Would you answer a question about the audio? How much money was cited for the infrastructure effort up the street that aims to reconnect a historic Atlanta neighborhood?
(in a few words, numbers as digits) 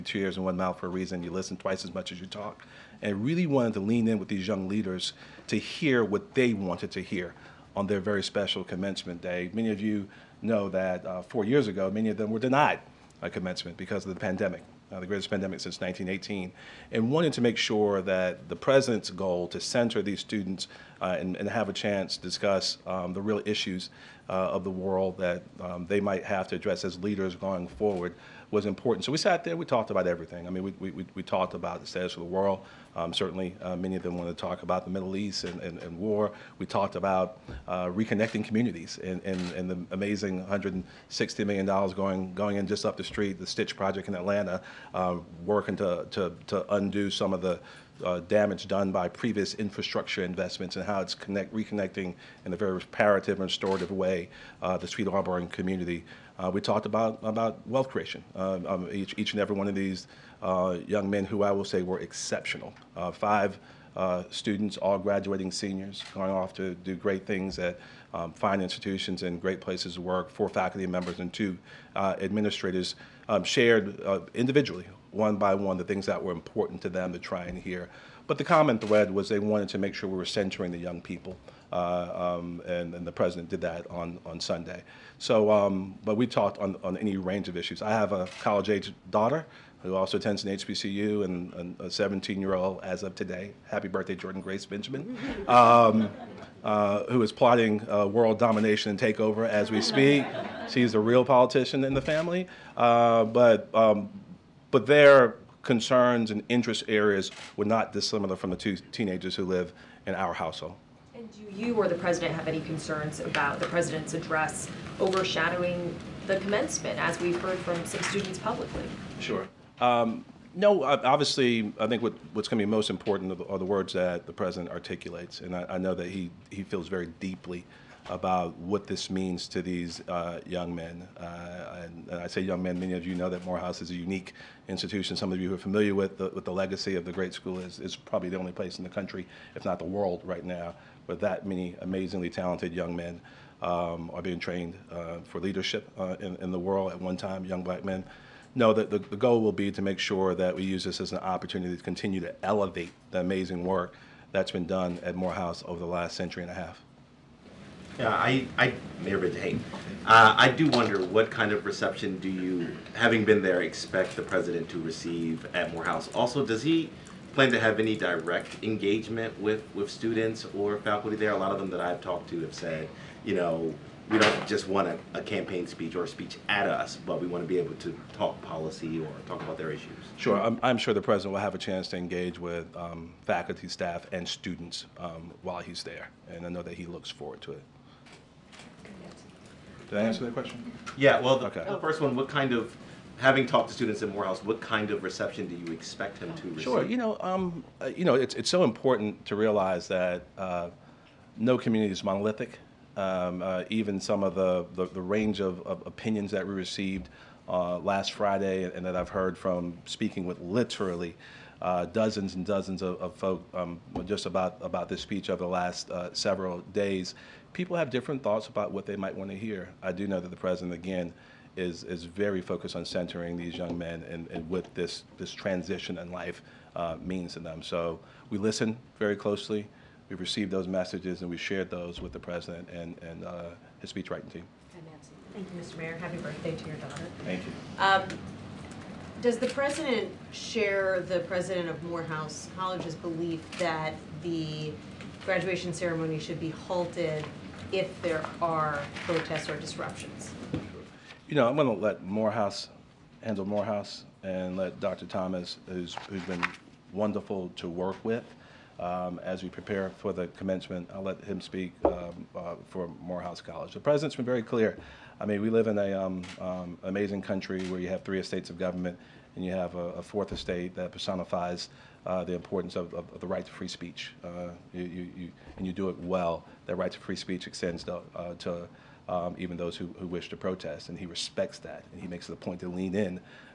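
$160 million.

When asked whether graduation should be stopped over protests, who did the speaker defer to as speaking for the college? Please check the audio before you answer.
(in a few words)
Dr. Thomas.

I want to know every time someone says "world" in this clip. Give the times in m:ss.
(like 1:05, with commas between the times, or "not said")
0:24, 0:32, 1:38, 2:19, 2:26.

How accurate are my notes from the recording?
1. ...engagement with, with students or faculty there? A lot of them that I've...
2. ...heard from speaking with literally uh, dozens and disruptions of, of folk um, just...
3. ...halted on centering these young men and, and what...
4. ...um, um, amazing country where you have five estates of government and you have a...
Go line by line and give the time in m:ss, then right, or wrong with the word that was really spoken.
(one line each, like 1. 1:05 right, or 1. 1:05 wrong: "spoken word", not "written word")
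1. 2:48 right
2. 3:29 wrong: "dozens", not "disruptions"
3. 3:42 wrong: "focused", not "halted"
4. 4:25 wrong: "three", not "five".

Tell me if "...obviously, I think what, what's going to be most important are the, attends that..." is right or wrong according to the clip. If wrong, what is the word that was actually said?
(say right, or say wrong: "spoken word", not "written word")
wrong: "words", not "attends".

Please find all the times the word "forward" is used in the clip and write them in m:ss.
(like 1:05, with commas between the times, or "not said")
0:27, 3:07.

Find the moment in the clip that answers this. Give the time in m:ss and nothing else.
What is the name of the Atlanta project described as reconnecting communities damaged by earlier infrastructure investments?
0:43.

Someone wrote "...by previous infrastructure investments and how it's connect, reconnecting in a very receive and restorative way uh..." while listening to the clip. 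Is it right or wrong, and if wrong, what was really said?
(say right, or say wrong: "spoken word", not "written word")
wrong: "reparative", not "receive".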